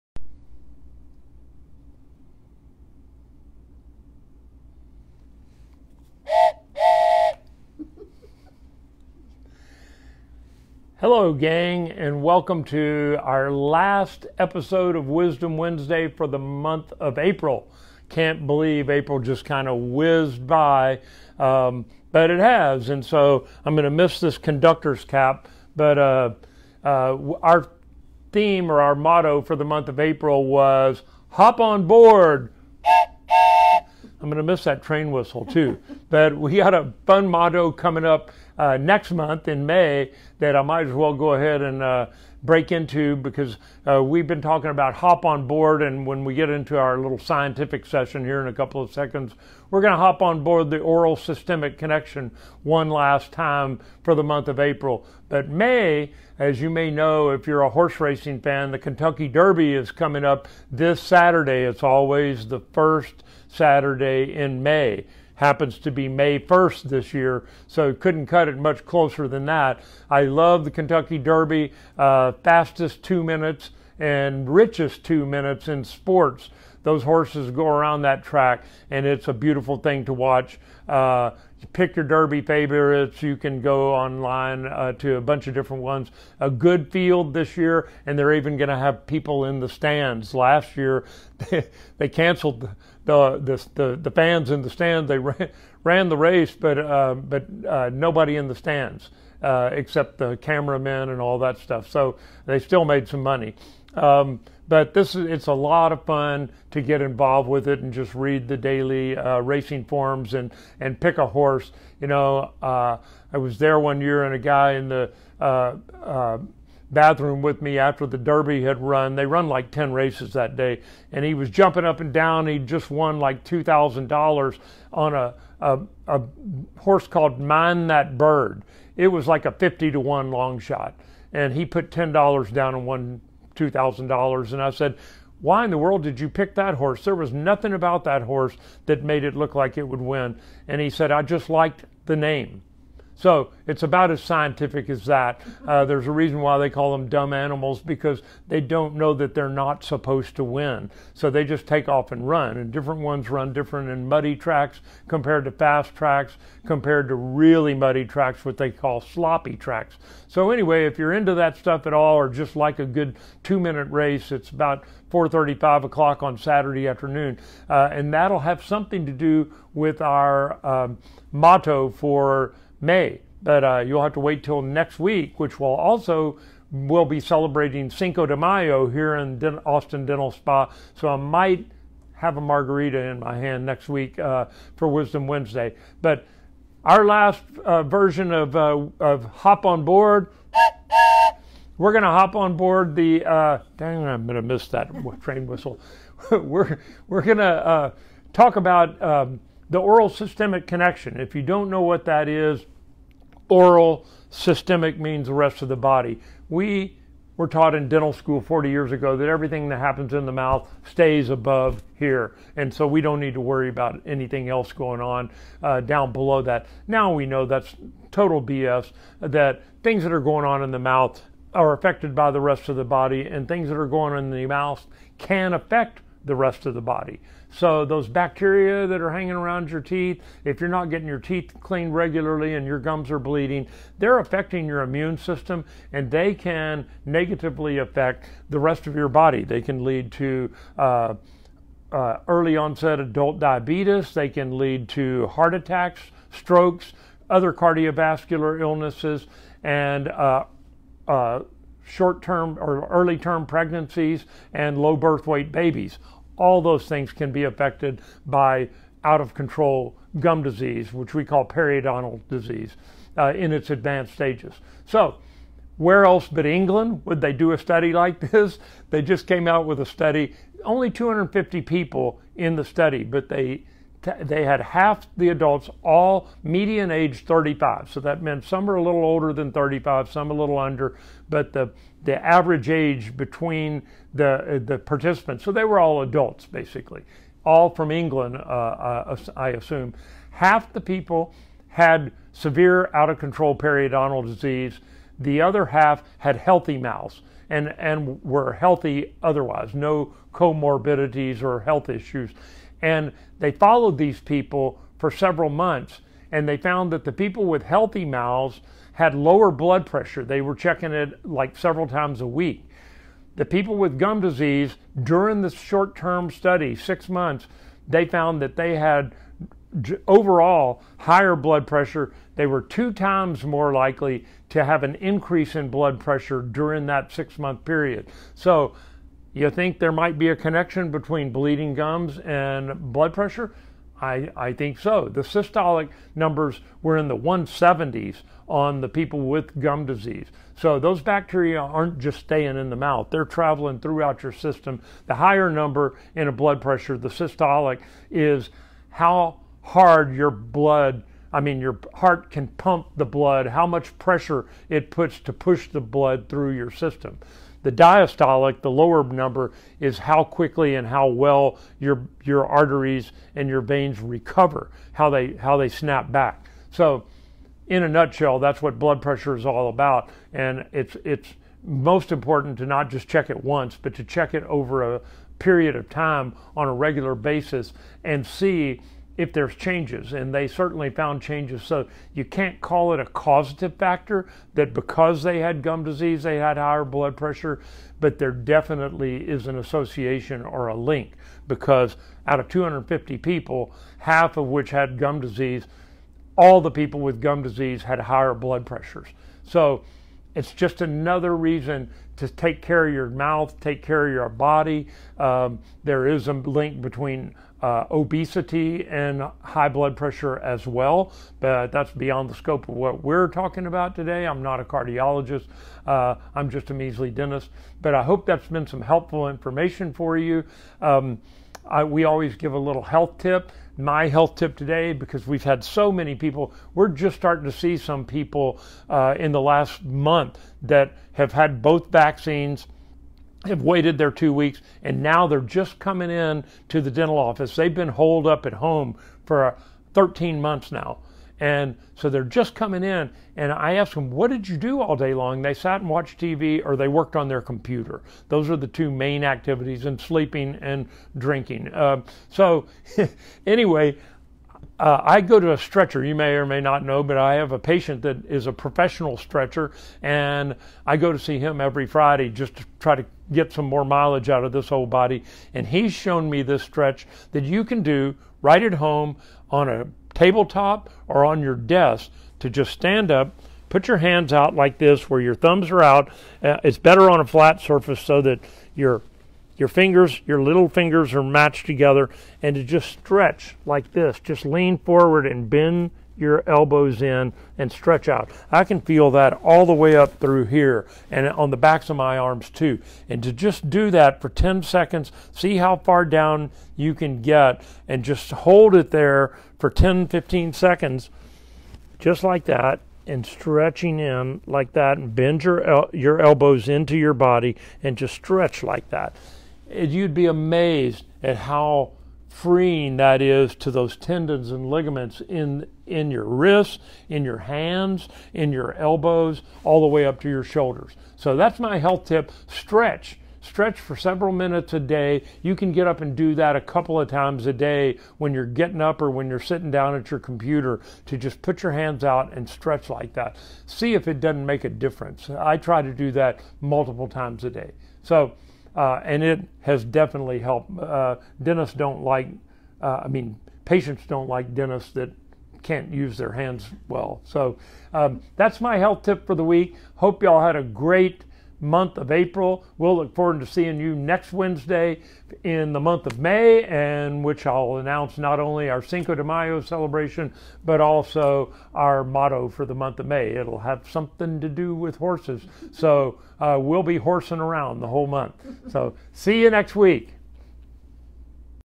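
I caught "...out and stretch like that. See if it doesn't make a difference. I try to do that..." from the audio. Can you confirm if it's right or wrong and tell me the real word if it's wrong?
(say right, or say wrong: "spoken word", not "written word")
right.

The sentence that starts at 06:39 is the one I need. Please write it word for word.
So it's just another reason to take care of your mouth, take care of your body.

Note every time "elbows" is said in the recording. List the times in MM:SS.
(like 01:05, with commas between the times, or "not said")
08:06, 08:26, 08:38.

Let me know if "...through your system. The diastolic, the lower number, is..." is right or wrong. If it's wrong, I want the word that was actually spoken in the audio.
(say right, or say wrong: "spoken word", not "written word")
right.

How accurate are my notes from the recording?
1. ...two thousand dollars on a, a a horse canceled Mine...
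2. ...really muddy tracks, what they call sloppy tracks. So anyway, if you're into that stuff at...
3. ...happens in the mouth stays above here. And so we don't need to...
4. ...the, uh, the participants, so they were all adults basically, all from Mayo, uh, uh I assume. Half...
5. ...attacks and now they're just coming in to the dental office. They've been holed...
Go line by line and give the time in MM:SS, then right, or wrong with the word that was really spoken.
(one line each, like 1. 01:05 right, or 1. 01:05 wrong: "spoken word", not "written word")
1. 02:03 wrong: "called", not "canceled"
2. 02:37 right
3. 03:29 right
4. 04:44 wrong: "England", not "Mayo"
5. 07:14 wrong: "weeks", not "attacks".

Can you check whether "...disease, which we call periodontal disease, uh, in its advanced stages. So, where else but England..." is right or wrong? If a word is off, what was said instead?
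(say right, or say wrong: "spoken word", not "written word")
right.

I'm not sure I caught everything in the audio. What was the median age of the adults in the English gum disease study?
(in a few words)
35.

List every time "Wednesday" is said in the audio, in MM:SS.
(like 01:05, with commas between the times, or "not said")
00:15, 03:05, 09:14.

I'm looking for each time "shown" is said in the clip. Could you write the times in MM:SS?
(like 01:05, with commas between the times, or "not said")
07:45.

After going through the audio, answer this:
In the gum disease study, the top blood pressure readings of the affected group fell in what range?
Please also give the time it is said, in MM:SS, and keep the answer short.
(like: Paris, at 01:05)
170s, at 05:37.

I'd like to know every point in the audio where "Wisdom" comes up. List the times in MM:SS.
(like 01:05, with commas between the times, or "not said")
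00:15, 03:04.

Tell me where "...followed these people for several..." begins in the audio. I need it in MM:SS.
05:03.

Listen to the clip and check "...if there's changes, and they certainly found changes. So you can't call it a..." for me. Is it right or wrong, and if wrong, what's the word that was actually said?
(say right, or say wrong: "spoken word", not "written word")
right.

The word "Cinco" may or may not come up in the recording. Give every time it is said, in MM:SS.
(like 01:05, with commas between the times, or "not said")
02:57, 09:18.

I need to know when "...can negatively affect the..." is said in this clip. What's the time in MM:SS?
03:56.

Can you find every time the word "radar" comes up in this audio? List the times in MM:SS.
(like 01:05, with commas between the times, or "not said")
not said.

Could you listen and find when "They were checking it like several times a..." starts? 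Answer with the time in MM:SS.
05:10.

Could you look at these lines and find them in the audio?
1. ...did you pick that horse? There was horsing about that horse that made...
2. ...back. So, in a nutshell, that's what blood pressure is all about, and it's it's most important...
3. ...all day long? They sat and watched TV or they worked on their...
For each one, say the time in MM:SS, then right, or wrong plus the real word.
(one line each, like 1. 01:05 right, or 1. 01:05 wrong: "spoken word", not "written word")
1. 02:16 wrong: "nothing", not "horsing"
2. 06:06 right
3. 07:24 right.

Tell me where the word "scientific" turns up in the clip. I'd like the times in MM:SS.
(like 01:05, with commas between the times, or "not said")
00:47, 02:24.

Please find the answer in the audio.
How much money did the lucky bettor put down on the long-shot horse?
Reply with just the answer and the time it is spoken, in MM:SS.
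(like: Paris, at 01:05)
$10, at 02:11.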